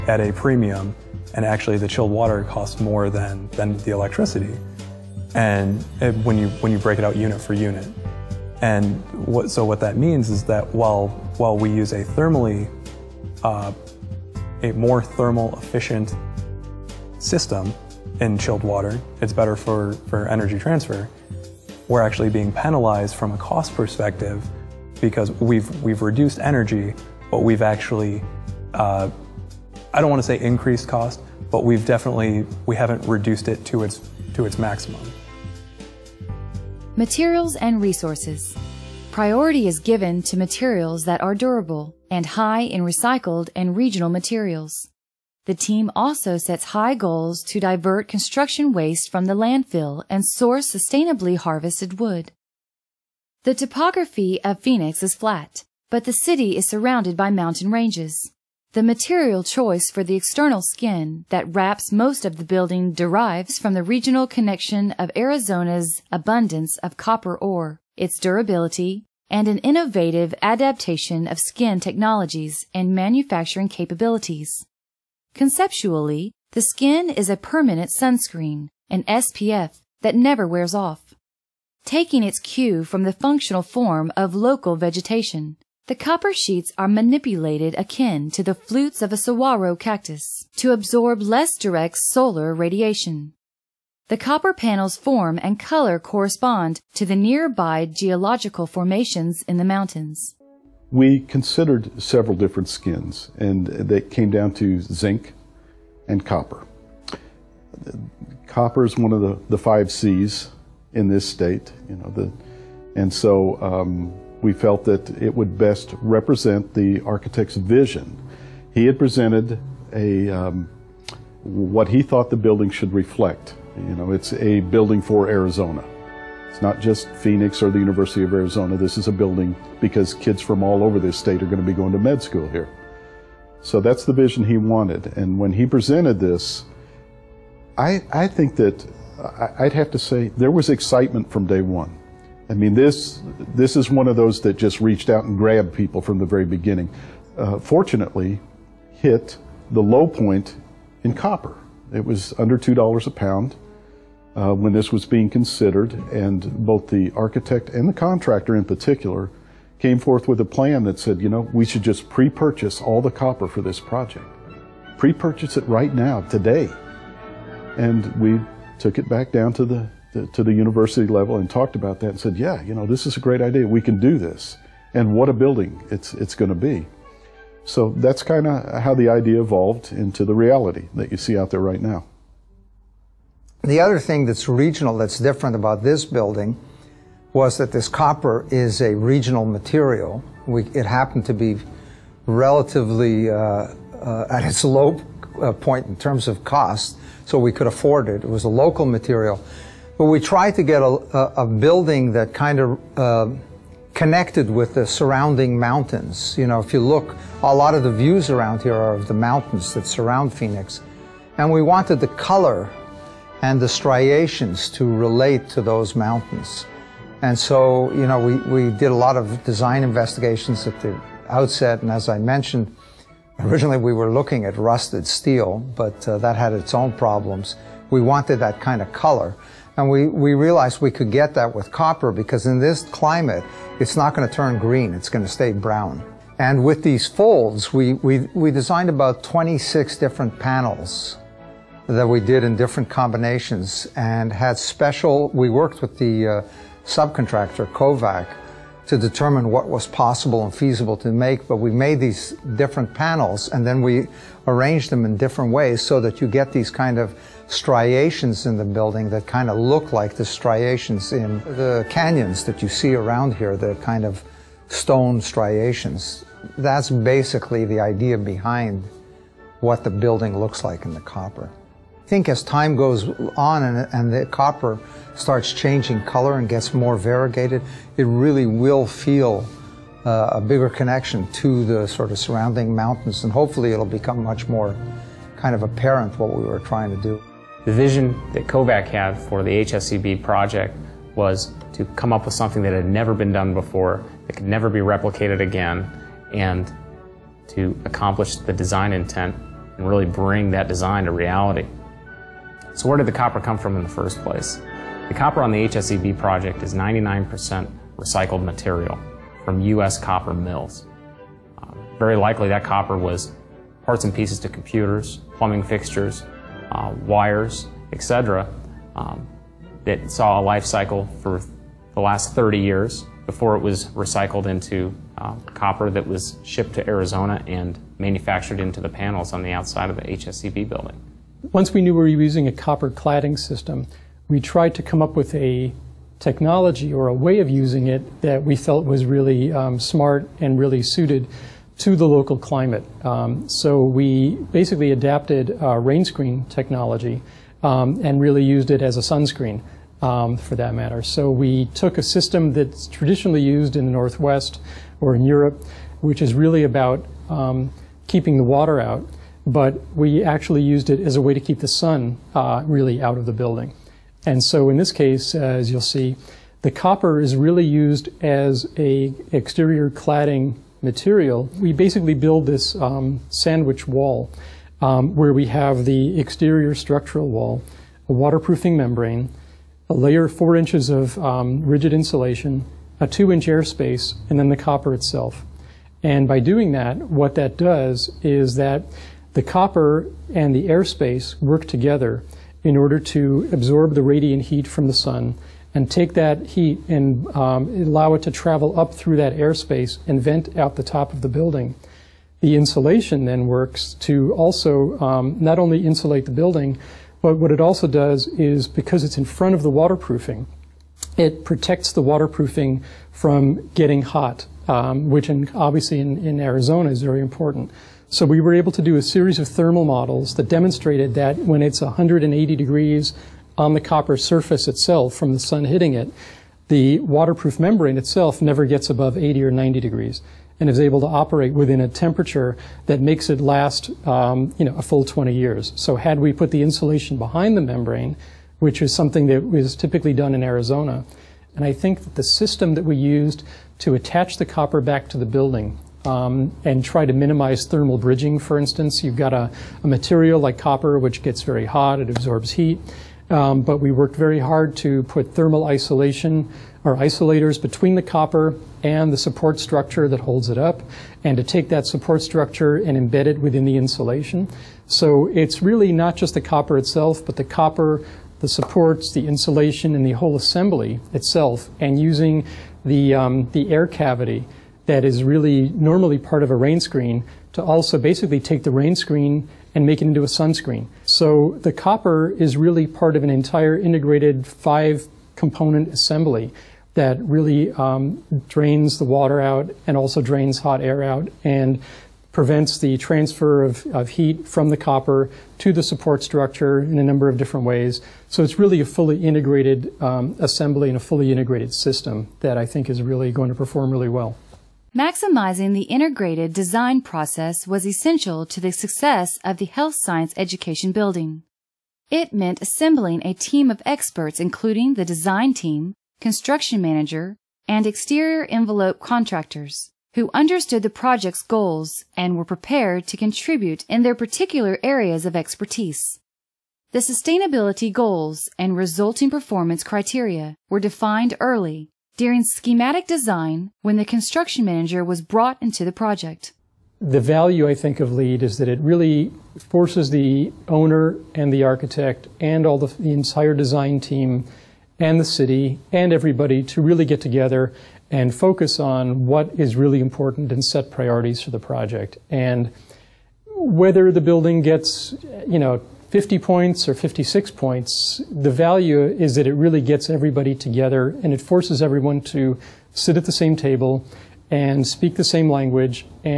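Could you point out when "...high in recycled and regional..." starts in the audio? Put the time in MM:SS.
00:42.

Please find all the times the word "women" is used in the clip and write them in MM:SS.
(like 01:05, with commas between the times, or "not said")
not said.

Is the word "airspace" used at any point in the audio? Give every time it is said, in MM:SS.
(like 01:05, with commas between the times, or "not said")
06:23, 06:30, 06:39.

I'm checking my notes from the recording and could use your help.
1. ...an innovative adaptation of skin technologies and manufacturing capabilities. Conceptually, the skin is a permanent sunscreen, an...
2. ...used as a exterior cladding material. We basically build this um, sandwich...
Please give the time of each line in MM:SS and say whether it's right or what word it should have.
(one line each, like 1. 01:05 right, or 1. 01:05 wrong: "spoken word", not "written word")
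1. 01:09 right
2. 06:07 right.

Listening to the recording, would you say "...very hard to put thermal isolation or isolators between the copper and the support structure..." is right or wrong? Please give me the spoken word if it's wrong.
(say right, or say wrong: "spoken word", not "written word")
right.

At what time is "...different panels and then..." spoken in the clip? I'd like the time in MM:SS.
04:12.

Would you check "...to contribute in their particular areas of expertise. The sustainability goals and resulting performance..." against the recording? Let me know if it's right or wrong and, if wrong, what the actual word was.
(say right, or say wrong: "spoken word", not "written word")
right.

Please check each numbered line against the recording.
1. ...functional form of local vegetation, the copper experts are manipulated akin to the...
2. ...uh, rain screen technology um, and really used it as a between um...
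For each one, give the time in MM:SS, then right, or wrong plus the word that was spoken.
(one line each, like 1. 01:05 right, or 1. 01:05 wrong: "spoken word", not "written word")
1. 01:23 wrong: "sheets", not "experts"
2. 05:45 wrong: "sunscreen", not "between".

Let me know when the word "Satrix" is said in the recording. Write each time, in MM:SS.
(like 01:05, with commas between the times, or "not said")
not said.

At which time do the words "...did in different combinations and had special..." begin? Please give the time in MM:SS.
04:02.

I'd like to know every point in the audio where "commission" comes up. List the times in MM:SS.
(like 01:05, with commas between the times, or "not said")
not said.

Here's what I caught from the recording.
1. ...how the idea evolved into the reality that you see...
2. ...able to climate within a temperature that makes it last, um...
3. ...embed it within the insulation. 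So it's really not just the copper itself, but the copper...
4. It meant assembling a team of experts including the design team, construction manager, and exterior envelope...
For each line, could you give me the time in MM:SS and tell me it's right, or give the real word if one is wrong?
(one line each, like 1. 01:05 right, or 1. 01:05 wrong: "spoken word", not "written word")
1. 02:58 right
2. 07:10 wrong: "operate", not "climate"
3. 07:42 right
4. 08:32 right.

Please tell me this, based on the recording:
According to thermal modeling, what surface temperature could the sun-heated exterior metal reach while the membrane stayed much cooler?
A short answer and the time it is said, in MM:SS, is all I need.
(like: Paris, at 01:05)
180 degrees, at 07:01.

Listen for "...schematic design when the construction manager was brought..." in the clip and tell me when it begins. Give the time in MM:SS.
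08:52.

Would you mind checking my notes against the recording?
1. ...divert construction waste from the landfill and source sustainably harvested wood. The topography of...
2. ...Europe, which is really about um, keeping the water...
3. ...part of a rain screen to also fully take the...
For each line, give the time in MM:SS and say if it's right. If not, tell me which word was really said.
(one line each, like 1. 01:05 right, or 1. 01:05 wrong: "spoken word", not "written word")
1. 00:47 right
2. 05:55 right
3. 07:56 wrong: "basically", not "fully".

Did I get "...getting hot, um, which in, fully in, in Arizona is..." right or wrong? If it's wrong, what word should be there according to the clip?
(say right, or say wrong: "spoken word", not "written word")
wrong: "obviously", not "fully".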